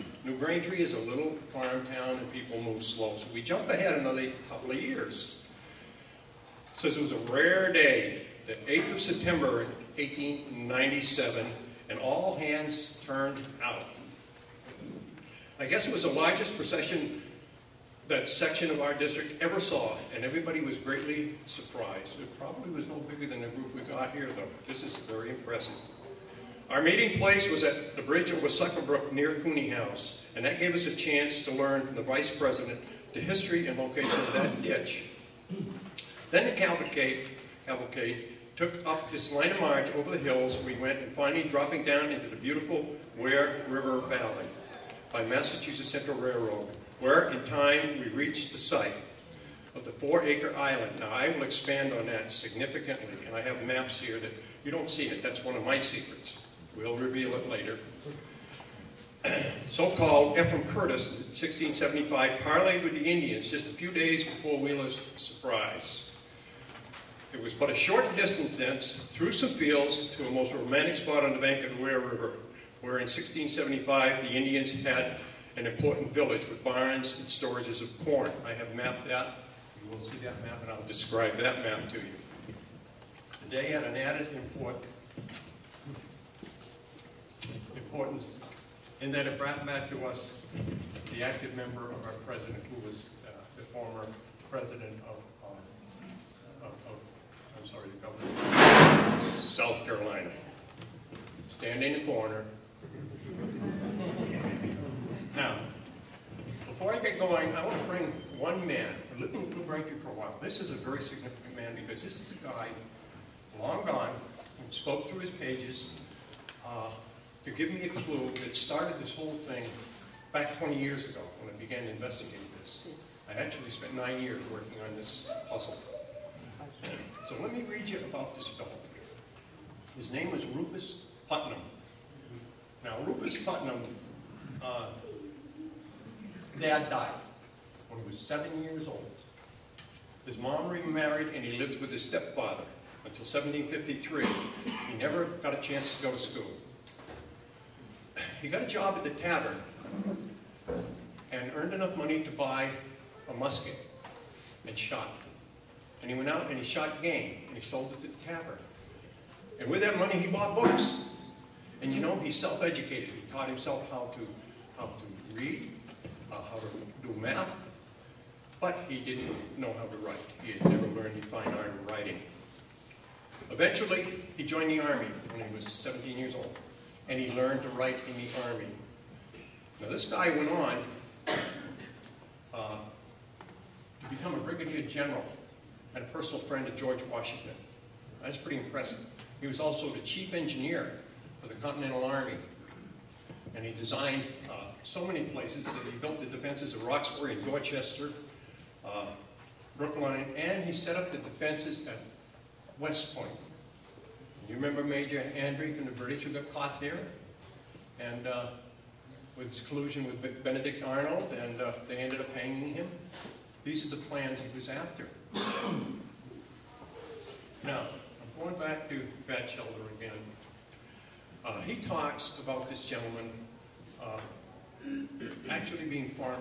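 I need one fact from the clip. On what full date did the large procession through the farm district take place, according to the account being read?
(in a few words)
8 September 1897.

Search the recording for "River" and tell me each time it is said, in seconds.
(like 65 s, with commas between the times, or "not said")
43 s, 72 s.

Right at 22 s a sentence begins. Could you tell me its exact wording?
It probably was no bigger than the group we got here, though.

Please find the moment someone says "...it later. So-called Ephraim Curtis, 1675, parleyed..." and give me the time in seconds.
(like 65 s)
57 s.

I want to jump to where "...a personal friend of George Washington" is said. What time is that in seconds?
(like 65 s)
186 s.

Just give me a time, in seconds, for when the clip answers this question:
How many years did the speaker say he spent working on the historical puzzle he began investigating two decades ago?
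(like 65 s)
123 s.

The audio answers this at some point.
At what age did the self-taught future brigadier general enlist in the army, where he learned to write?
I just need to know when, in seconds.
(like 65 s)
175 s.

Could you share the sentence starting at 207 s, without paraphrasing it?
And uh, with his collusion with Benedict Arnold, and uh, they ended up hanging him.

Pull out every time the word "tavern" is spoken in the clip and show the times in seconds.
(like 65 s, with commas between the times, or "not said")
149 s, 158 s.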